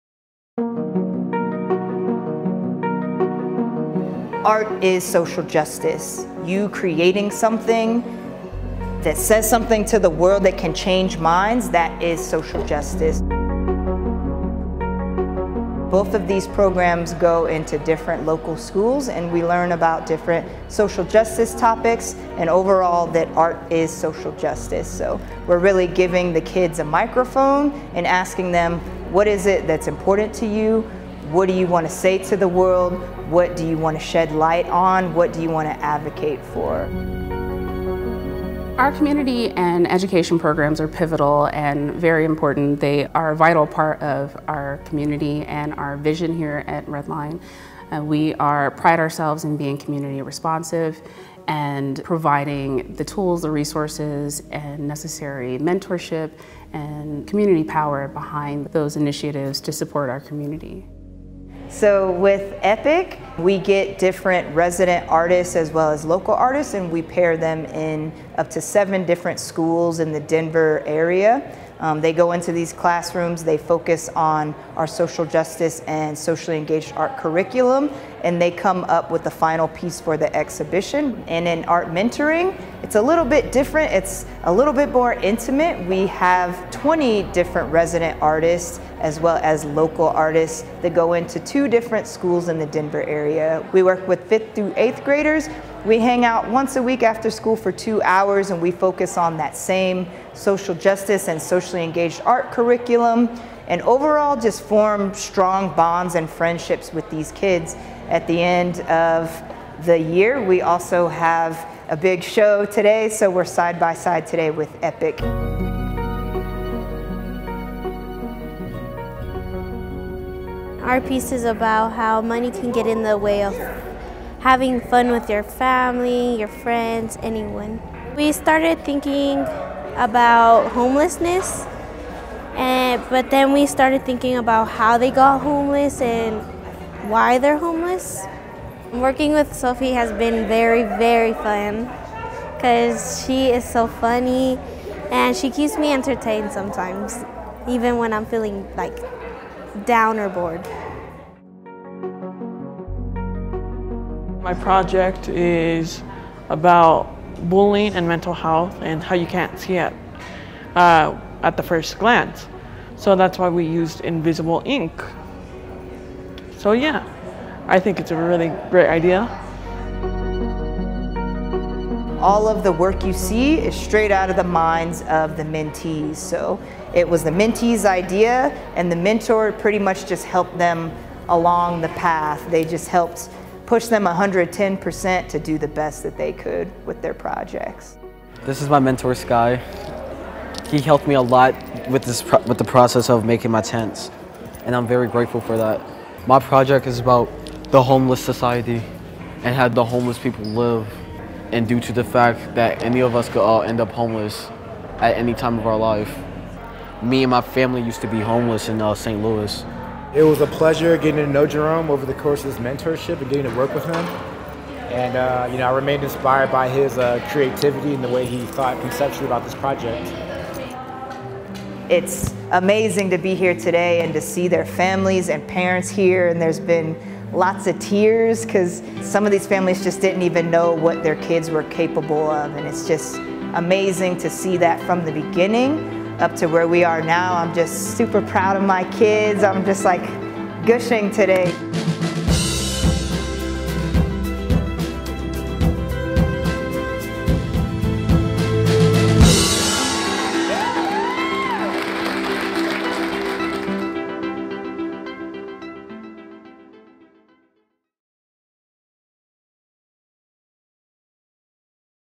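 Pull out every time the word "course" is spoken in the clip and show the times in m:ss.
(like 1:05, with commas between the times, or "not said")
3:32.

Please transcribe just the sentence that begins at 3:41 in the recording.
It's amazing to be here today and to see their families and parents here.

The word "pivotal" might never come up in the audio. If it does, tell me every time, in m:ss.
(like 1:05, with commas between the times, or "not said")
0:40.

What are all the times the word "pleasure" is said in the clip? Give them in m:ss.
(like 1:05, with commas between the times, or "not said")
3:30.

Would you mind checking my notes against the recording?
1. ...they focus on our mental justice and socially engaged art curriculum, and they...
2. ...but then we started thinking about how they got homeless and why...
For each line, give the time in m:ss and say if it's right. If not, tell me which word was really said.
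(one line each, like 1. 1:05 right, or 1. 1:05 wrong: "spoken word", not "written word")
1. 1:13 wrong: "social", not "mental"
2. 2:13 right.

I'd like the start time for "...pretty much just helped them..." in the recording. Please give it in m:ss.
2:59.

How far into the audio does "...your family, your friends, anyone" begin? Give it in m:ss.
2:05.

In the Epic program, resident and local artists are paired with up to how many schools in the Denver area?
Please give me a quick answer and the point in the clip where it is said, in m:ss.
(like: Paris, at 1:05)
7, at 1:08.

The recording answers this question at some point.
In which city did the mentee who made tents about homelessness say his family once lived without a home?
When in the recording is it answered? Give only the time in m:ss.
3:28.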